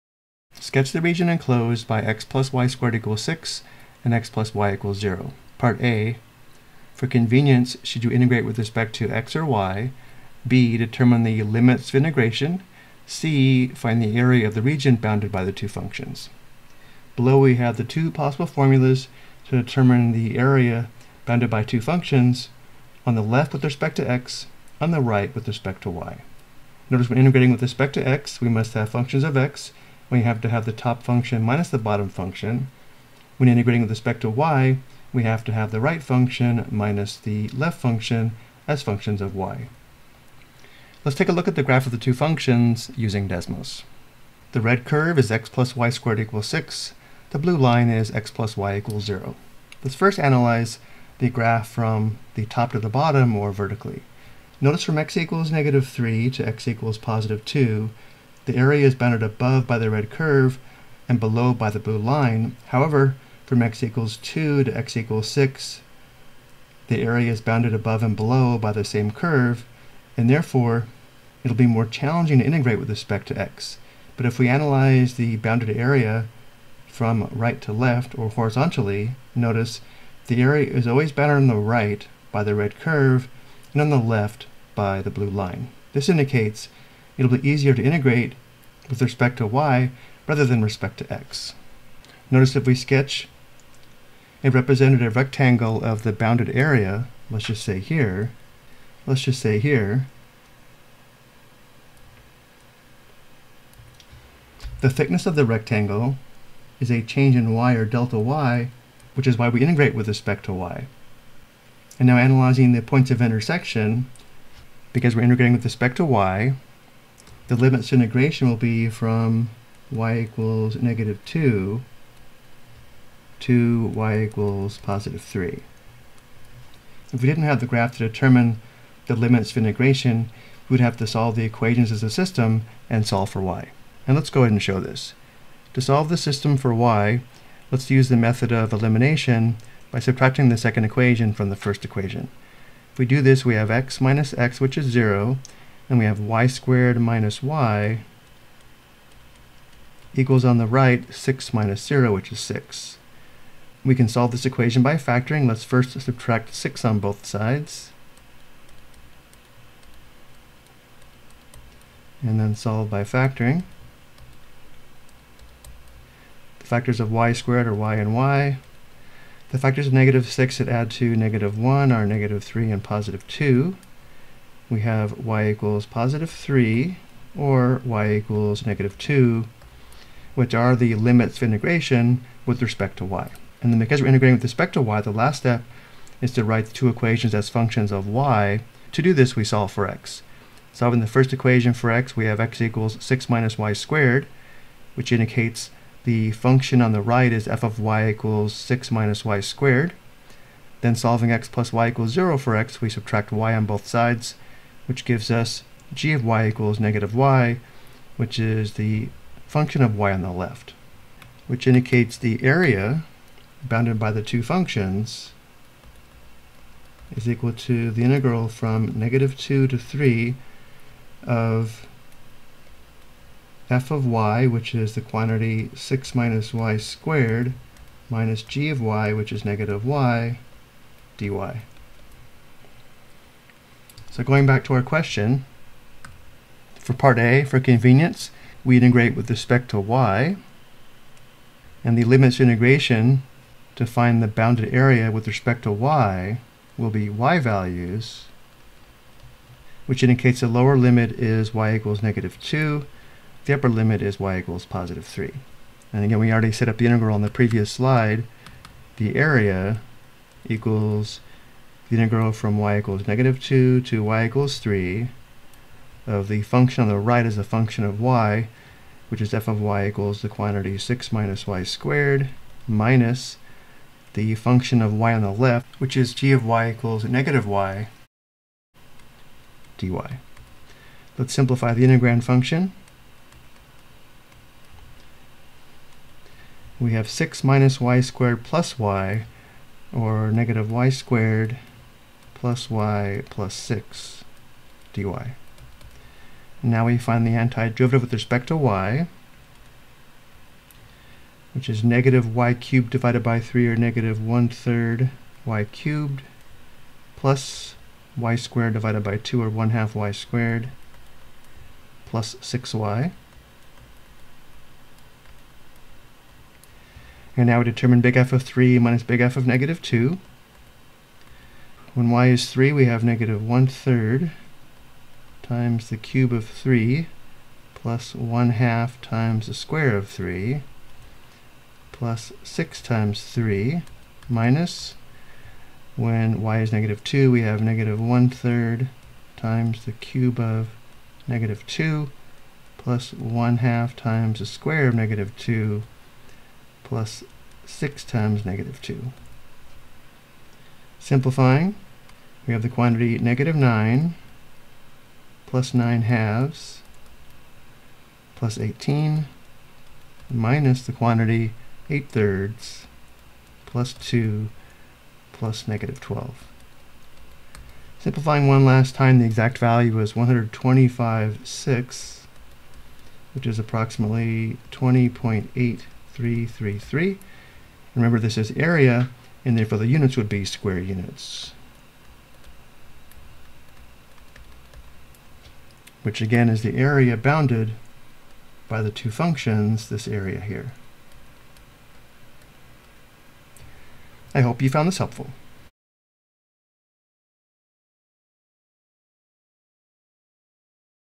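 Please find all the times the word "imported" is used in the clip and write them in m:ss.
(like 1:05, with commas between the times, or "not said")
not said.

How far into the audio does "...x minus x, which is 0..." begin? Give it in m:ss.
2:23.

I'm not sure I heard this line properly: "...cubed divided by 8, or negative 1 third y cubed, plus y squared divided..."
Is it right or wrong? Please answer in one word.
wrong.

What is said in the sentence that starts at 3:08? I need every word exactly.
To do this, we solve for x.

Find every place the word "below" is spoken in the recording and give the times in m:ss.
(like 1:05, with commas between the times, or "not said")
0:17, 1:01, 1:08.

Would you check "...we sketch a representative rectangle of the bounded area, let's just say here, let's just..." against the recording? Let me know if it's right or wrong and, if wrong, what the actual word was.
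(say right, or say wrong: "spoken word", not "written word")
right.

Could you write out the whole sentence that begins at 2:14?
And let's go ahead and show this.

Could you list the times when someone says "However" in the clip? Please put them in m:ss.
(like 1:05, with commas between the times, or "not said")
1:02.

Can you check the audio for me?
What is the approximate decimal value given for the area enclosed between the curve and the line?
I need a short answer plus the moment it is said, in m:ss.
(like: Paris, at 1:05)
20.8333, at 6:14.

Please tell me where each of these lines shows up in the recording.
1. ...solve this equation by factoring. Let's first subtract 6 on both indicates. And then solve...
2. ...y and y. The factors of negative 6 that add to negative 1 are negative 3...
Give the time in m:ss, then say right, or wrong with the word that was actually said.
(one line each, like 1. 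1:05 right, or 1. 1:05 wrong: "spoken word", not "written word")
1. 2:34 wrong: "sides", not "indicates"
2. 2:47 right.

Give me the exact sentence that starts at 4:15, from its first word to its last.
And again, we already set up the integral on the previous slide.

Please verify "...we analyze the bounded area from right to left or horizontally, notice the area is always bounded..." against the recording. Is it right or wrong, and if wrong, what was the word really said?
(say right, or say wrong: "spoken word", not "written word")
right.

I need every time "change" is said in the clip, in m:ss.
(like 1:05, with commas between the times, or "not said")
1:47.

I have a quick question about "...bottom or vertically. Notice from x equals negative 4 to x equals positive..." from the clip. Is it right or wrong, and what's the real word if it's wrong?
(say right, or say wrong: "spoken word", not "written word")
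wrong: "3", not "4".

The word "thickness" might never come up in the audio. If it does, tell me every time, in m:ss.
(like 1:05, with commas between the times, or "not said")
1:44.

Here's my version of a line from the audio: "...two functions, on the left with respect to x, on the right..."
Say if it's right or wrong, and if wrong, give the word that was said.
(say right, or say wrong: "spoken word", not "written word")
right.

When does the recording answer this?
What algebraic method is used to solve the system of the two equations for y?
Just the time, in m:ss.
2:18.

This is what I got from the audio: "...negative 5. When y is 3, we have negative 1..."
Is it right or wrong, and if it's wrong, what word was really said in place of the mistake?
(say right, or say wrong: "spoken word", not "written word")
wrong: "2", not "5".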